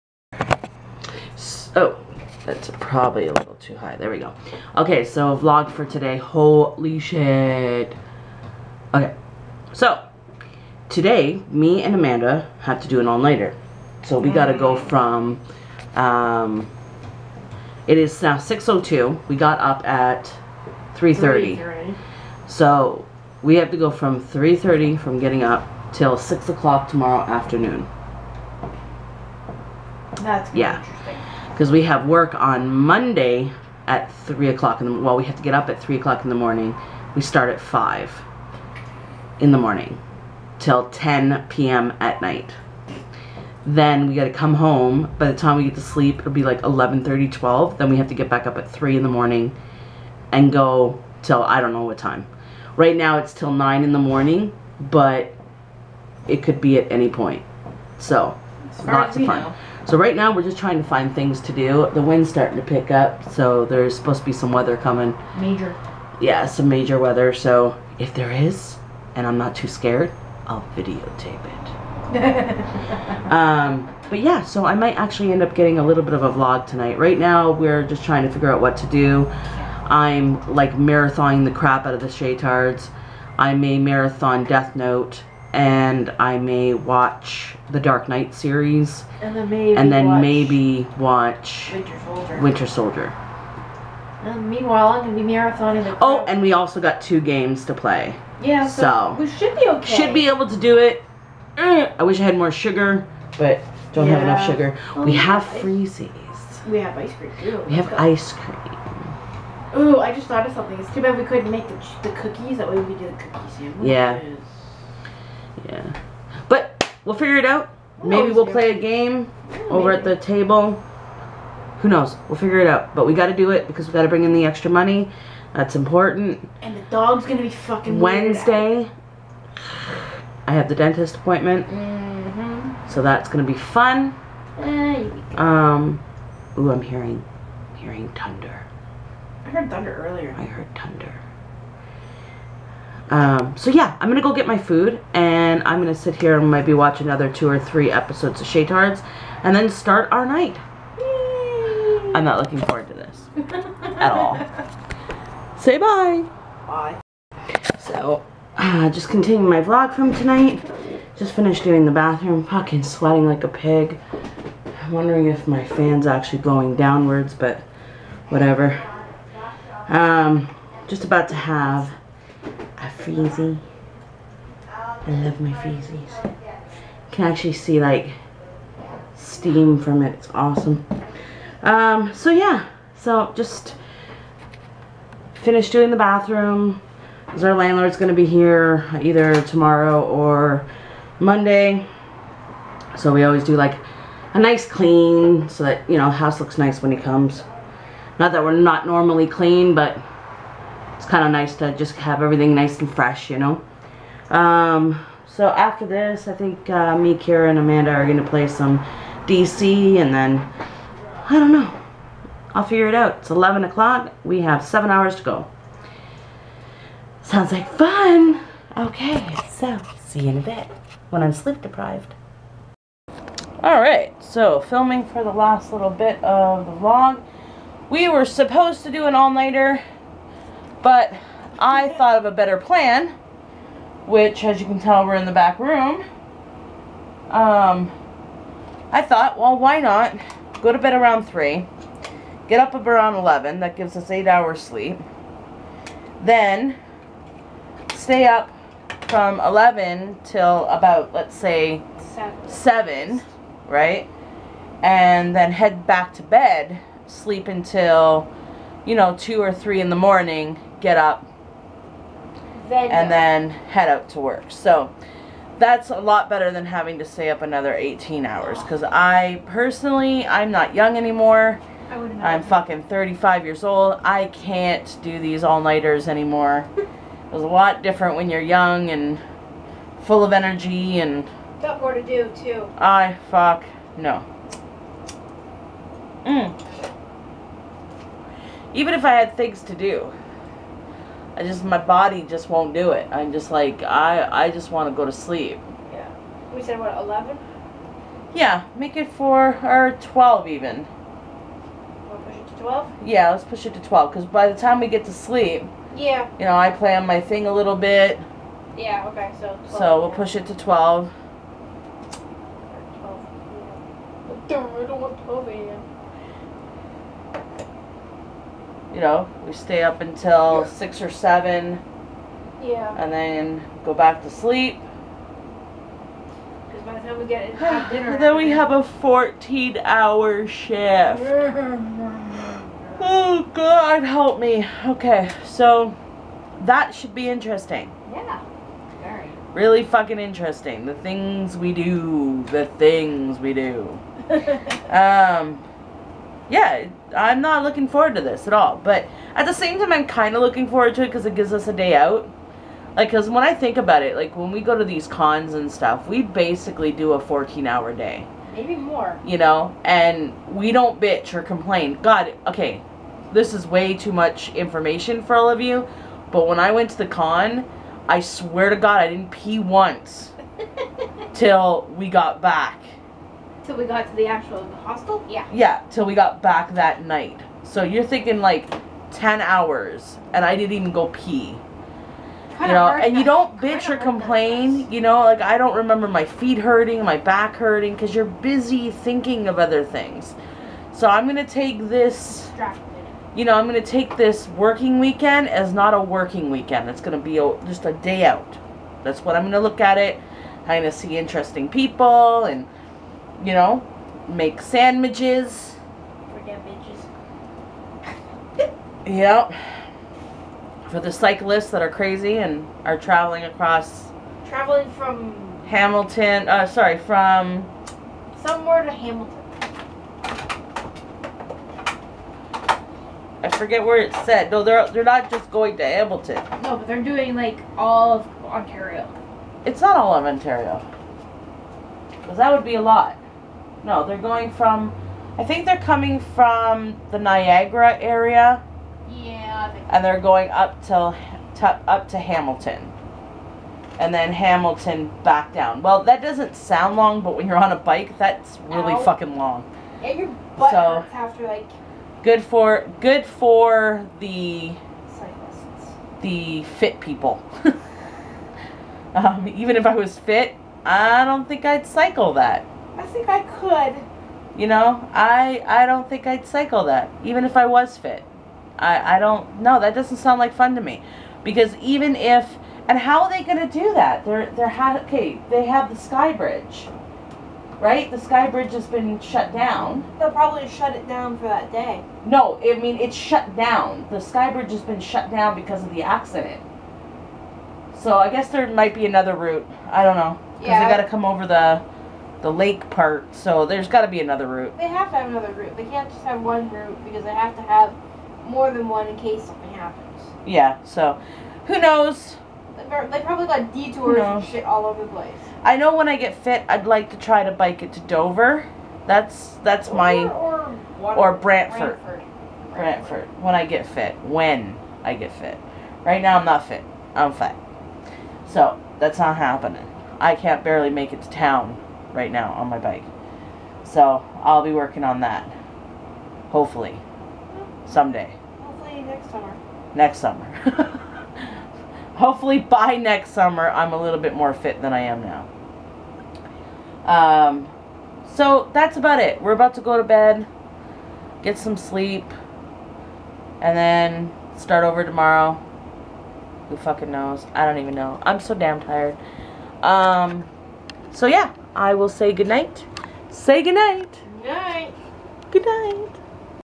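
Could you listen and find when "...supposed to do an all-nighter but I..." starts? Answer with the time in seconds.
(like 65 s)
228 s.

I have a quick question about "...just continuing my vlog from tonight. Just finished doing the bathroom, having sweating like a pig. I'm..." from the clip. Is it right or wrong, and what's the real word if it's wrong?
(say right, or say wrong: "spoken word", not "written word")
wrong: "fucking", not "having".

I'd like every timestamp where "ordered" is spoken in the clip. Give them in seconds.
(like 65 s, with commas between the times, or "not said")
not said.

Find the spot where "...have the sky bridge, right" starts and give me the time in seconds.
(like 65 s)
475 s.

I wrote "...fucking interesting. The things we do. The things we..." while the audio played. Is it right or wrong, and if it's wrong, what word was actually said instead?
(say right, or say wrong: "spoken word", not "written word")
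right.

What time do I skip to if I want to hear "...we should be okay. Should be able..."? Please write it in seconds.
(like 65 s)
99 s.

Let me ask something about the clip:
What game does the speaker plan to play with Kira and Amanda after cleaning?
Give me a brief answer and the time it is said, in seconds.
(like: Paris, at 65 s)
DC, at 208 s.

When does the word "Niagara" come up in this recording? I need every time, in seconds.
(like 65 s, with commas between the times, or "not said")
437 s.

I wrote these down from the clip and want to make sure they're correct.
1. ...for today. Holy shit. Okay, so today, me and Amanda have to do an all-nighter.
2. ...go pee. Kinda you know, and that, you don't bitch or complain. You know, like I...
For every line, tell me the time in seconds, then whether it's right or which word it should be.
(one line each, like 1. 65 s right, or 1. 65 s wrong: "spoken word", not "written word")
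1. 5 s right
2. 380 s right.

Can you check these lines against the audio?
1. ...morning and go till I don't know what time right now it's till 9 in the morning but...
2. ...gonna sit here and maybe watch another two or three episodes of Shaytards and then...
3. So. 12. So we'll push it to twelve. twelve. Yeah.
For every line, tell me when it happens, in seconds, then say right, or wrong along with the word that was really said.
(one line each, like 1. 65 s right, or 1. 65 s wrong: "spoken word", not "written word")
1. 49 s right
2. 145 s right
3. 309 s right.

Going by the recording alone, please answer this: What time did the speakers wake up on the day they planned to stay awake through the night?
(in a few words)
3:30.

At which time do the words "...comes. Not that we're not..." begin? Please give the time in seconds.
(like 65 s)
196 s.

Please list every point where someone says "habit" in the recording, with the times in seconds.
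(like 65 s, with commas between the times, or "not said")
not said.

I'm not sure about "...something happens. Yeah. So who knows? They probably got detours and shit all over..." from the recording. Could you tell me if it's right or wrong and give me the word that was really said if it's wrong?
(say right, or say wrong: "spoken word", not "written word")
right.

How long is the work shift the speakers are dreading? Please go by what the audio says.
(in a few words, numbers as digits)
14 hours.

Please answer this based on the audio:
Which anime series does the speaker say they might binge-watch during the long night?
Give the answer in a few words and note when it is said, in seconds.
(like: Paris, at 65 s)
Death Note, at 84 s.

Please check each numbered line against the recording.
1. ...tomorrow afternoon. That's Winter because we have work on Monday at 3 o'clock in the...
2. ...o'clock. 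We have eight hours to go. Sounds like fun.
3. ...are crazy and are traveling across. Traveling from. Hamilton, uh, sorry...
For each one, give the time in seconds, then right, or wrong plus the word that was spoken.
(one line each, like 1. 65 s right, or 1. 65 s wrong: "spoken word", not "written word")
1. 26 s wrong: "Yeah", not "Winter"
2. 213 s wrong: "seven", not "eight"
3. 411 s right.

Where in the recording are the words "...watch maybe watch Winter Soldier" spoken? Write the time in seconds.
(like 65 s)
90 s.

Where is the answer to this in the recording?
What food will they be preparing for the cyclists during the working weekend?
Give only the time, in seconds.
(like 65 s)
404 s.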